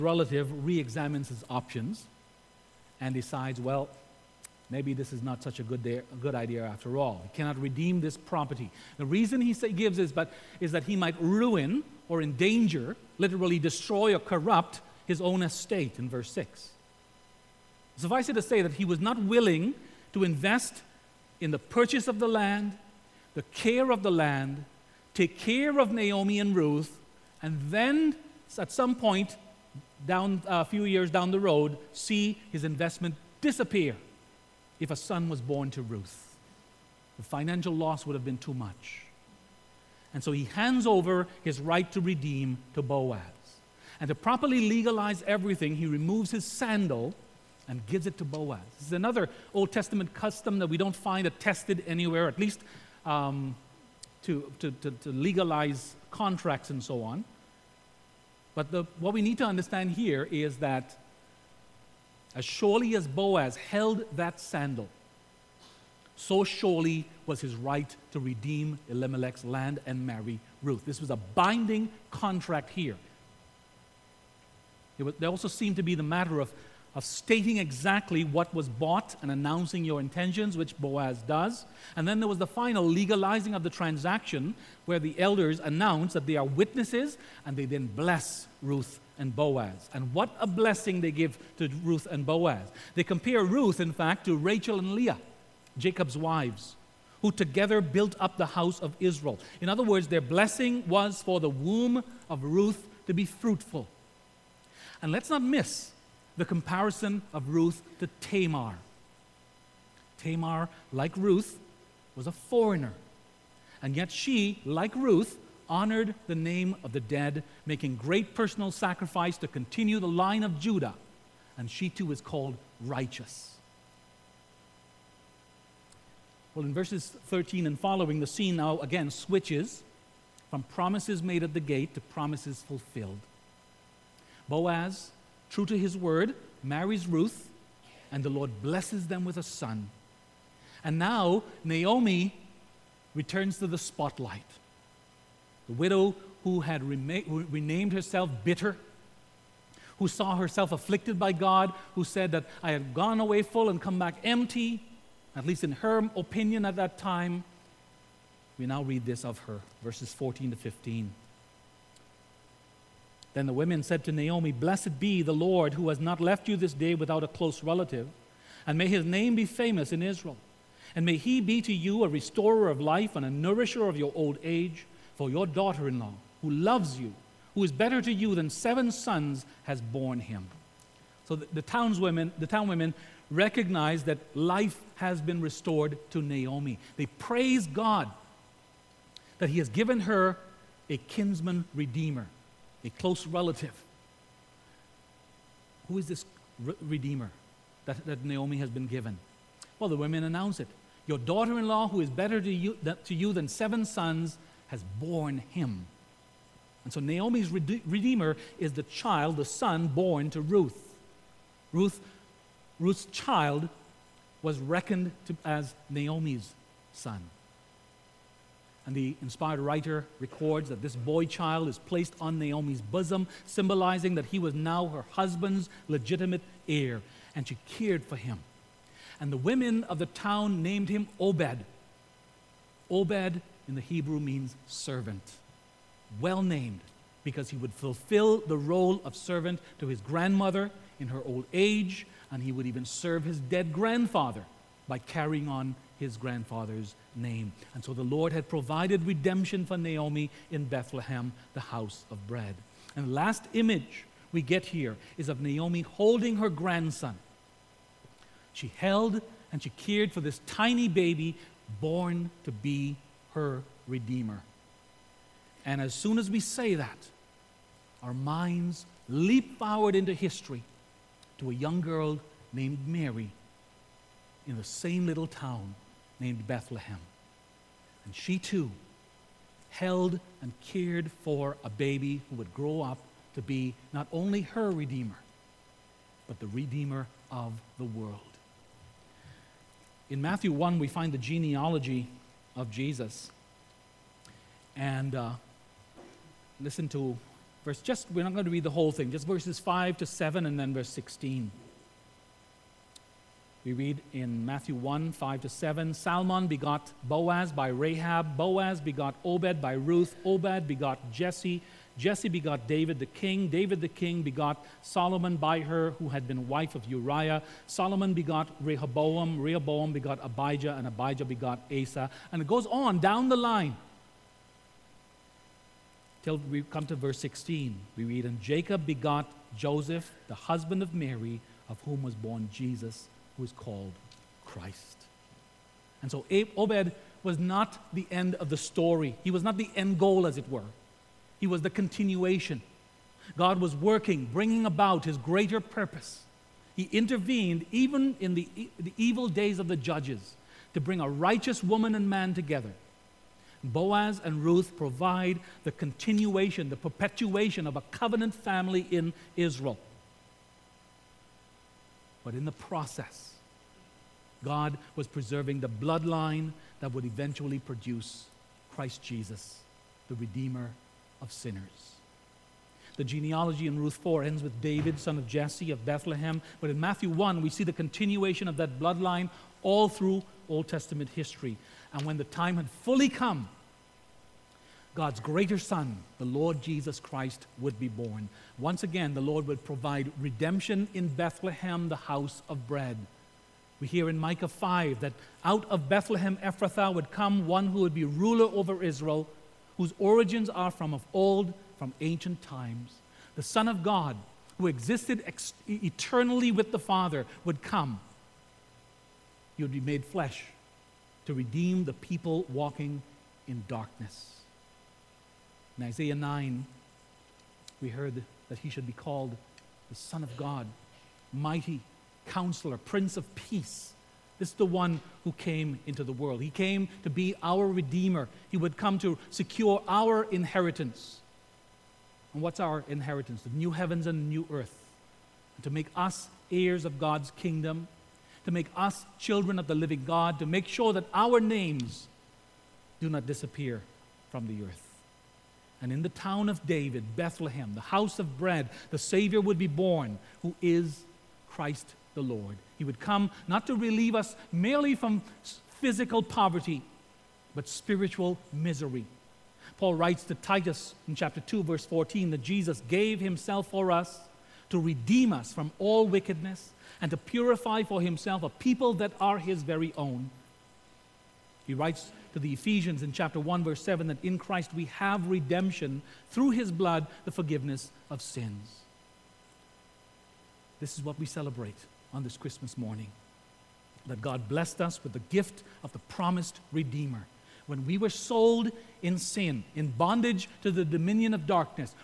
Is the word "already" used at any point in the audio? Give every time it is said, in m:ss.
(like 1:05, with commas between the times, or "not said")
not said.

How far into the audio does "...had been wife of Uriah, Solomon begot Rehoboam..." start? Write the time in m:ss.
5:16.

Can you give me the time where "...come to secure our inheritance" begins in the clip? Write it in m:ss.
7:08.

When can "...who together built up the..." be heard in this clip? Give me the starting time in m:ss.
1:37.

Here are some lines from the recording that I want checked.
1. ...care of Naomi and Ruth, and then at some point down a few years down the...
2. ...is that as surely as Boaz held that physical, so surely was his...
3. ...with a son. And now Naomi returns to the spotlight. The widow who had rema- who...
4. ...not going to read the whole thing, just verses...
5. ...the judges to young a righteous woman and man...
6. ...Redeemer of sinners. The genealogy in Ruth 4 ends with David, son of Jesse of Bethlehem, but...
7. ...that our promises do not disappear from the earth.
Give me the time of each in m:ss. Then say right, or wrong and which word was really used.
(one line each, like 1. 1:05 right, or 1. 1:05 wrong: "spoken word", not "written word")
1. 0:25 right
2. 1:00 wrong: "sandal", not "physical"
3. 2:19 right
4. 4:58 right
5. 5:49 wrong: "bring", not "young"
6. 6:10 right
7. 7:20 wrong: "names", not "promises".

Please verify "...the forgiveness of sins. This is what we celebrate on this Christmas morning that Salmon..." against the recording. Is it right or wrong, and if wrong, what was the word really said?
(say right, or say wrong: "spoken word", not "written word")
wrong: "God", not "Salmon".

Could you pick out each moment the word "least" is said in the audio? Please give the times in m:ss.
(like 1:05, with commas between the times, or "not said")
0:52, 2:35.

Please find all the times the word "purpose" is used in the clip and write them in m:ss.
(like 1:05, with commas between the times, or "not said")
5:45.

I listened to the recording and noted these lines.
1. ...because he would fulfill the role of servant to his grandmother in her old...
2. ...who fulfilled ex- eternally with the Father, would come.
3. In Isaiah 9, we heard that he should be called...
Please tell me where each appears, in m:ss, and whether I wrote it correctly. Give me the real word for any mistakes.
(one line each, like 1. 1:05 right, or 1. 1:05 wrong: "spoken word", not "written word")
1. 3:57 right
2. 6:44 wrong: "existed", not "fulfilled"
3. 6:55 right.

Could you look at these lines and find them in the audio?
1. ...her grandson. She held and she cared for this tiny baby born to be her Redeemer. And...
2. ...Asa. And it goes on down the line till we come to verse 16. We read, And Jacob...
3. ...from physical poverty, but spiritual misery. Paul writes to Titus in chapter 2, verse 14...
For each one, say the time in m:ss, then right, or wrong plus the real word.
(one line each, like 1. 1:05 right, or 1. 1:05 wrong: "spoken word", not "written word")
1. 4:16 right
2. 5:21 right
3. 7:34 right.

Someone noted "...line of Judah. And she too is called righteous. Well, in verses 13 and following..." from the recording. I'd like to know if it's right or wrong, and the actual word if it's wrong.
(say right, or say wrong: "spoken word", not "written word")
right.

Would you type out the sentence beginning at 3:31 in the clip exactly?
Ruth Ruth's child was reckoned to, as Naomi's son.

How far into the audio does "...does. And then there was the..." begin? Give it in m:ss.
1:21.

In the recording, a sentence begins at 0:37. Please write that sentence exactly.
The financial loss would have been too much.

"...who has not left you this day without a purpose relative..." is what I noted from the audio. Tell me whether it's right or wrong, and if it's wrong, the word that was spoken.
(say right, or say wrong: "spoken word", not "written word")
wrong: "close", not "purpose".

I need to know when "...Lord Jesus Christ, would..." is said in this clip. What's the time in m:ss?
6:26.